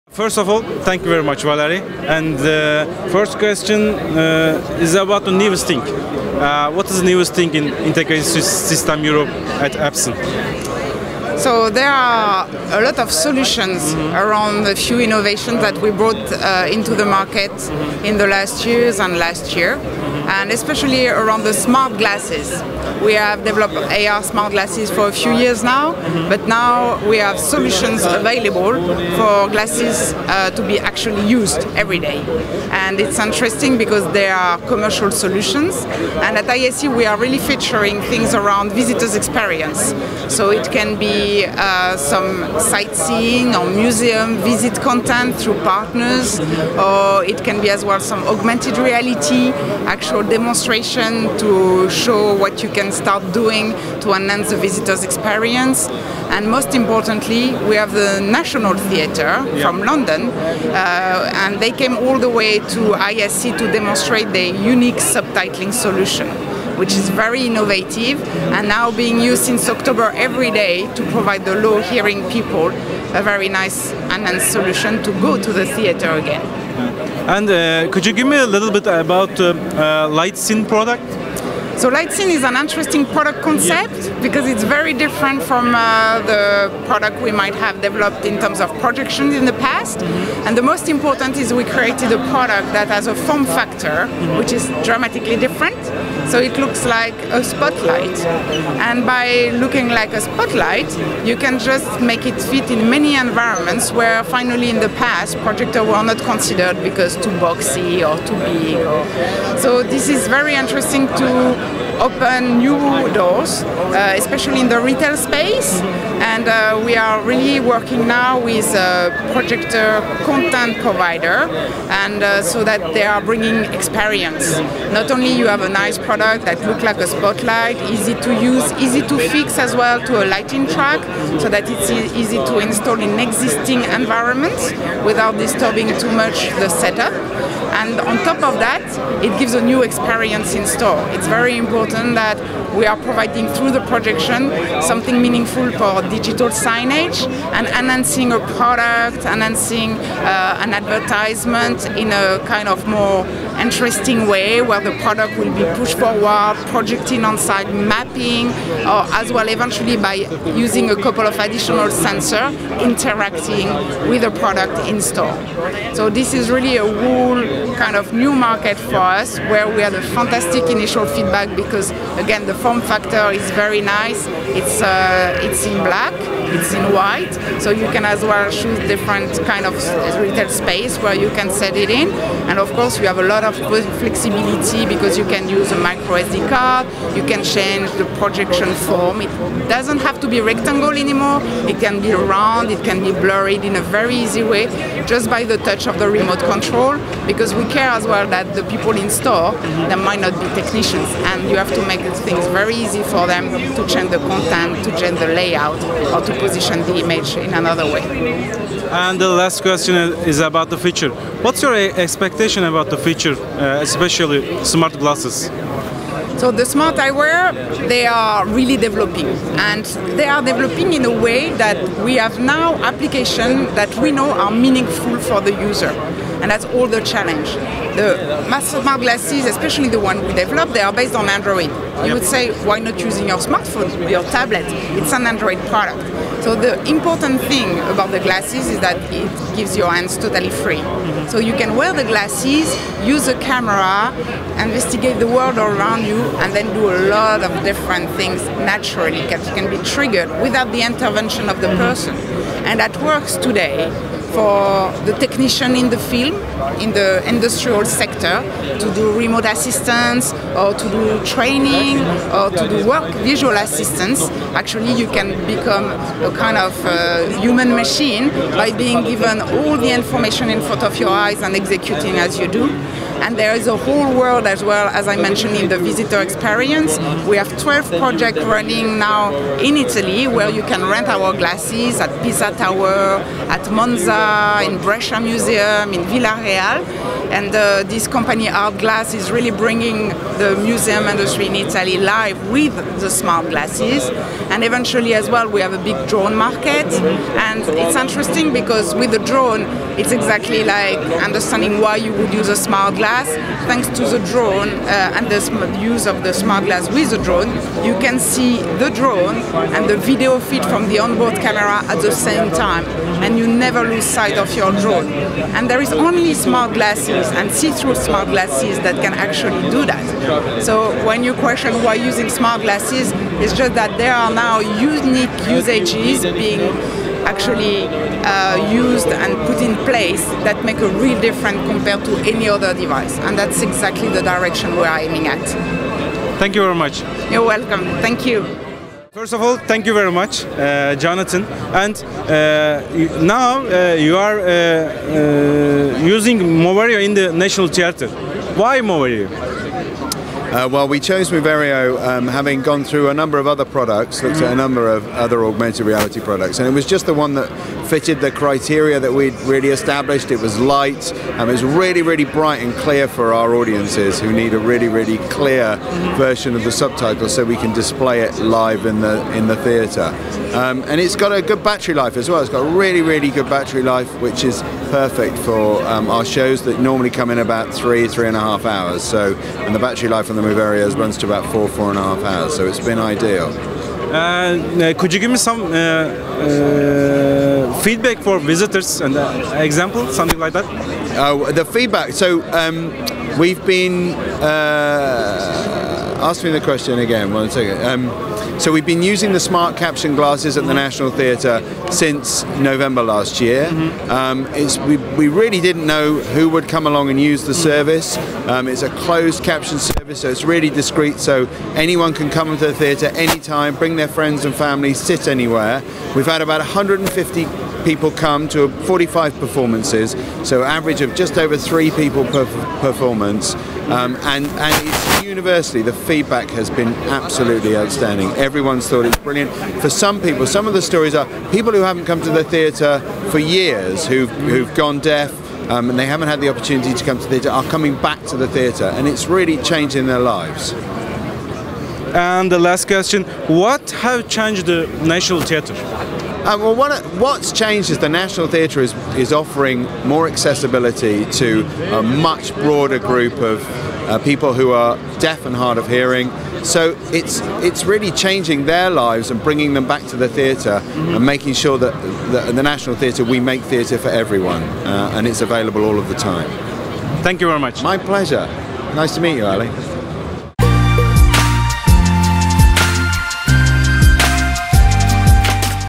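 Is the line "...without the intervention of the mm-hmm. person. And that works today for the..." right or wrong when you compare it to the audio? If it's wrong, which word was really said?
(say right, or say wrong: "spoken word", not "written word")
right.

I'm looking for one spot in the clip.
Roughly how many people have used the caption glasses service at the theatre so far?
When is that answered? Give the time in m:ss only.
6:56.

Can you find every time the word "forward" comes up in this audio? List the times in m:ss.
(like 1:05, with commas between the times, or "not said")
2:35.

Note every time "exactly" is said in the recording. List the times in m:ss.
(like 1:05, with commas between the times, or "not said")
5:00, 5:33.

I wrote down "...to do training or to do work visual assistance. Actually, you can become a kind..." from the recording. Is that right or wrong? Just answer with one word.
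right.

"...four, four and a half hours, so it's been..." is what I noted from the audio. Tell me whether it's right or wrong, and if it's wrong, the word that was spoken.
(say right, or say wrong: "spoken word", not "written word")
right.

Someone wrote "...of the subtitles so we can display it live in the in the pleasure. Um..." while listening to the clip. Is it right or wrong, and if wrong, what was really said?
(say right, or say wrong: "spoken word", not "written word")
wrong: "theatre", not "pleasure".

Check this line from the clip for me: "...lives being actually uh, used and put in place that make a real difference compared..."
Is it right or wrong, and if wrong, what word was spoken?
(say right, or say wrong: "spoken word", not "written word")
wrong: "usages", not "lives".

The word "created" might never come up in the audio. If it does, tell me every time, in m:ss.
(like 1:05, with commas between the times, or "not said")
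1:31.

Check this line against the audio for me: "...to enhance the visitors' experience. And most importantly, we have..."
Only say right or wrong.
right.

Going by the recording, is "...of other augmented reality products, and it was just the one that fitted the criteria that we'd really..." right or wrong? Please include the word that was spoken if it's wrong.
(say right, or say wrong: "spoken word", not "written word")
right.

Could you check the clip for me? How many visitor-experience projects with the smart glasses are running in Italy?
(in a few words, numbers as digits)
12.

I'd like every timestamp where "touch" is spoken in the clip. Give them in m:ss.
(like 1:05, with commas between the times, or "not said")
3:15.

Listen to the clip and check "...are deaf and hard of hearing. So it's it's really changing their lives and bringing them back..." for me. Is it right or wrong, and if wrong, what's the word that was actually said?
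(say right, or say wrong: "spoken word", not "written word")
right.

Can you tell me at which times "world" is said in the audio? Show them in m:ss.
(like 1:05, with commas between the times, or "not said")
4:05, 4:34.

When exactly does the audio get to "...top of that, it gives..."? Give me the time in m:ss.
2:18.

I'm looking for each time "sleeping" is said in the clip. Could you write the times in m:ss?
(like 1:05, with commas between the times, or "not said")
not said.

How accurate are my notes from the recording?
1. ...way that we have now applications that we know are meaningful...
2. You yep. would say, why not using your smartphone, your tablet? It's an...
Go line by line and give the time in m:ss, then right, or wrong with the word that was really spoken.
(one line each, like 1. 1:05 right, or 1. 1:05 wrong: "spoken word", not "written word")
1. 3:41 right
2. 3:51 right.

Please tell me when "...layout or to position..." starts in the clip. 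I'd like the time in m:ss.
3:25.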